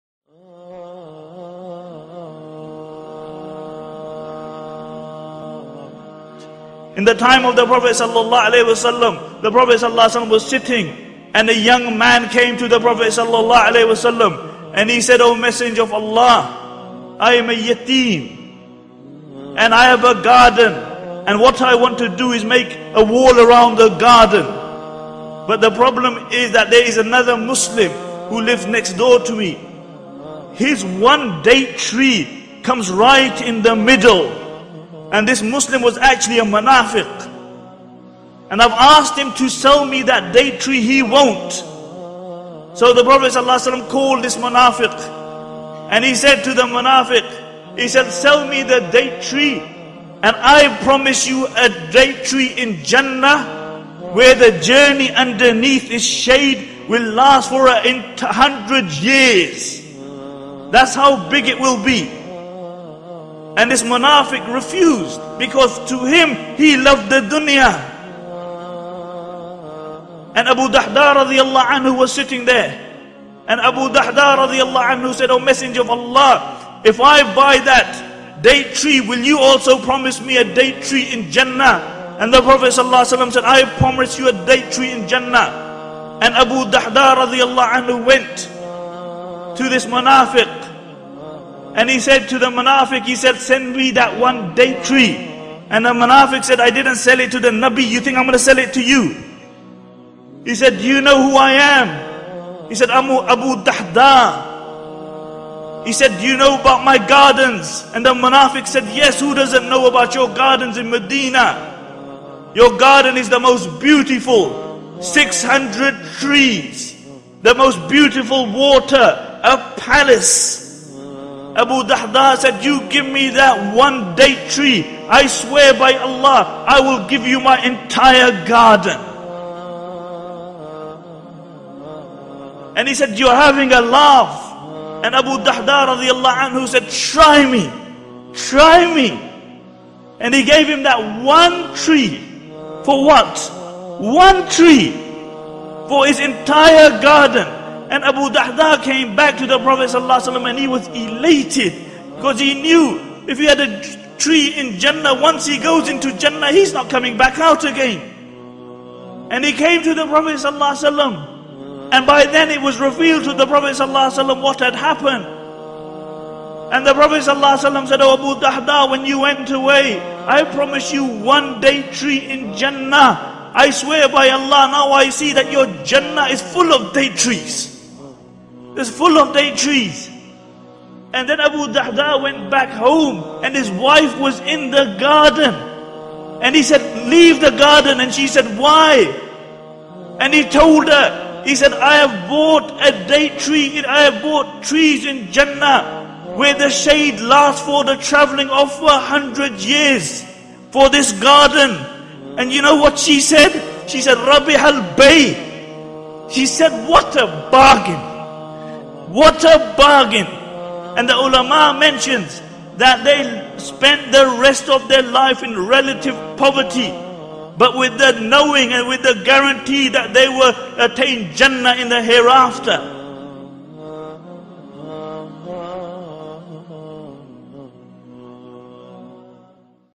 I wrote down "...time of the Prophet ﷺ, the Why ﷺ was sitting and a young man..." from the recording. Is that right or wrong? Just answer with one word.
wrong.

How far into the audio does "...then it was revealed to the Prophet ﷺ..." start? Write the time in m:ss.
2:42.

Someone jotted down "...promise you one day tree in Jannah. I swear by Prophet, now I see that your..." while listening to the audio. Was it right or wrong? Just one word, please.
wrong.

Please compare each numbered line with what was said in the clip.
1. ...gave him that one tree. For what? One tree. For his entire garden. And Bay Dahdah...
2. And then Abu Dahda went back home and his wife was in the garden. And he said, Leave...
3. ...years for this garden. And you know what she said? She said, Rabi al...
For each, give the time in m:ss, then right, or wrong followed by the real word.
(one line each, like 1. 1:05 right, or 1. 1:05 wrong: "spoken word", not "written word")
1. 2:20 wrong: "Abu", not "Bay"
2. 3:01 right
3. 3:19 right.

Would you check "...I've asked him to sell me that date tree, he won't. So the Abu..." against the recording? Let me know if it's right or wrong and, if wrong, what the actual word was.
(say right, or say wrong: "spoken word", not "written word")
wrong: "Prophet", not "Abu".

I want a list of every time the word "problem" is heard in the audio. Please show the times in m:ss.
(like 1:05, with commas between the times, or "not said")
0:25.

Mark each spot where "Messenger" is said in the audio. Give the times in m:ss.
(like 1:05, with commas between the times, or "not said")
0:15, 1:15.